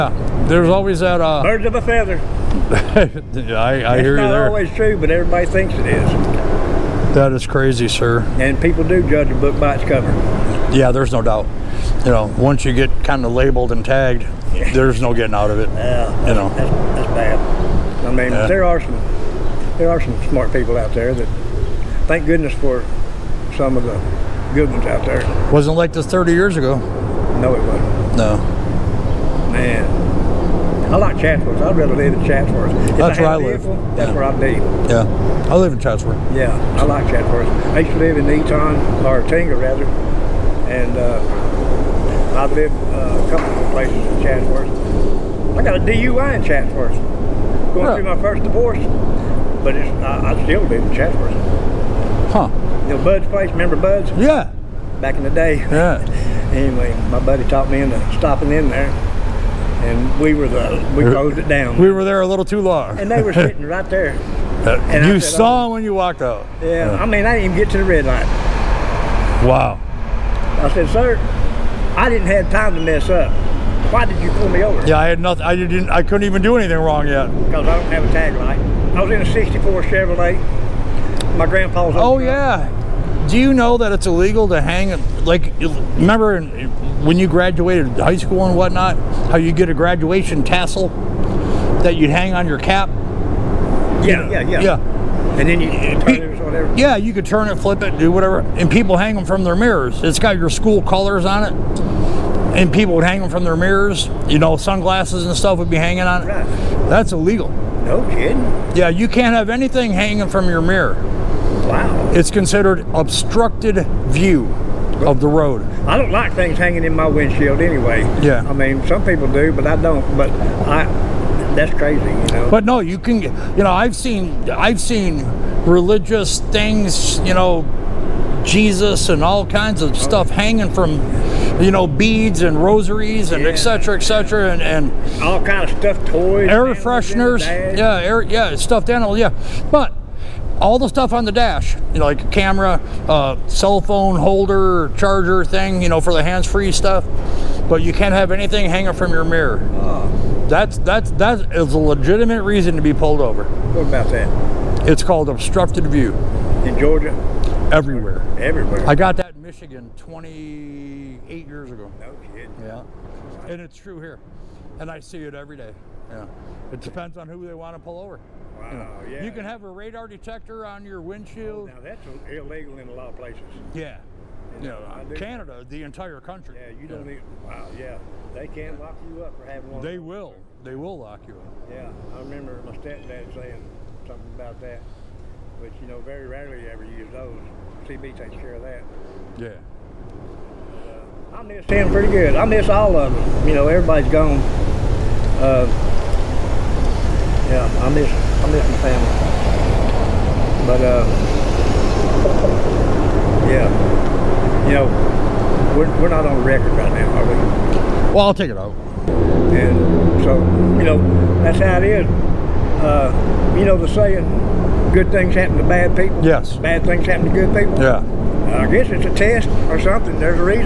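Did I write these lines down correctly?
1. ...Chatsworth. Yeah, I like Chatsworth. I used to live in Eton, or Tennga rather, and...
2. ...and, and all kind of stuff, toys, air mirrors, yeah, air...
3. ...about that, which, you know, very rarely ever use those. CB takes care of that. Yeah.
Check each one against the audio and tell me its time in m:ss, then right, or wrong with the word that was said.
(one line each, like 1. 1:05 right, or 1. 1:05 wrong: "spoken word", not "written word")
1. 0:35 right
2. 2:14 wrong: "fresheners", not "mirrors"
3. 3:04 right.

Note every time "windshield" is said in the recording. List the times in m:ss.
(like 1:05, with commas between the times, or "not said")
1:57, 2:51.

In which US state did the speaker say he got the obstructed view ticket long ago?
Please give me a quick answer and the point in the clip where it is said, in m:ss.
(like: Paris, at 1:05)
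Michigan, at 2:39.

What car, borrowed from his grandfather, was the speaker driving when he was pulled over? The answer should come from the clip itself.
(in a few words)
1964 Chevrolet.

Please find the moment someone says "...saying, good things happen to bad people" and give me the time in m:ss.
3:33.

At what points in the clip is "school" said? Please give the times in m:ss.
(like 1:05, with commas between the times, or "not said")
1:28, 1:40.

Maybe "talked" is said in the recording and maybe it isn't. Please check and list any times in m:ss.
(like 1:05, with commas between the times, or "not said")
0:57.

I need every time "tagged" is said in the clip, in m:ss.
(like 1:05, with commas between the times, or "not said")
0:13.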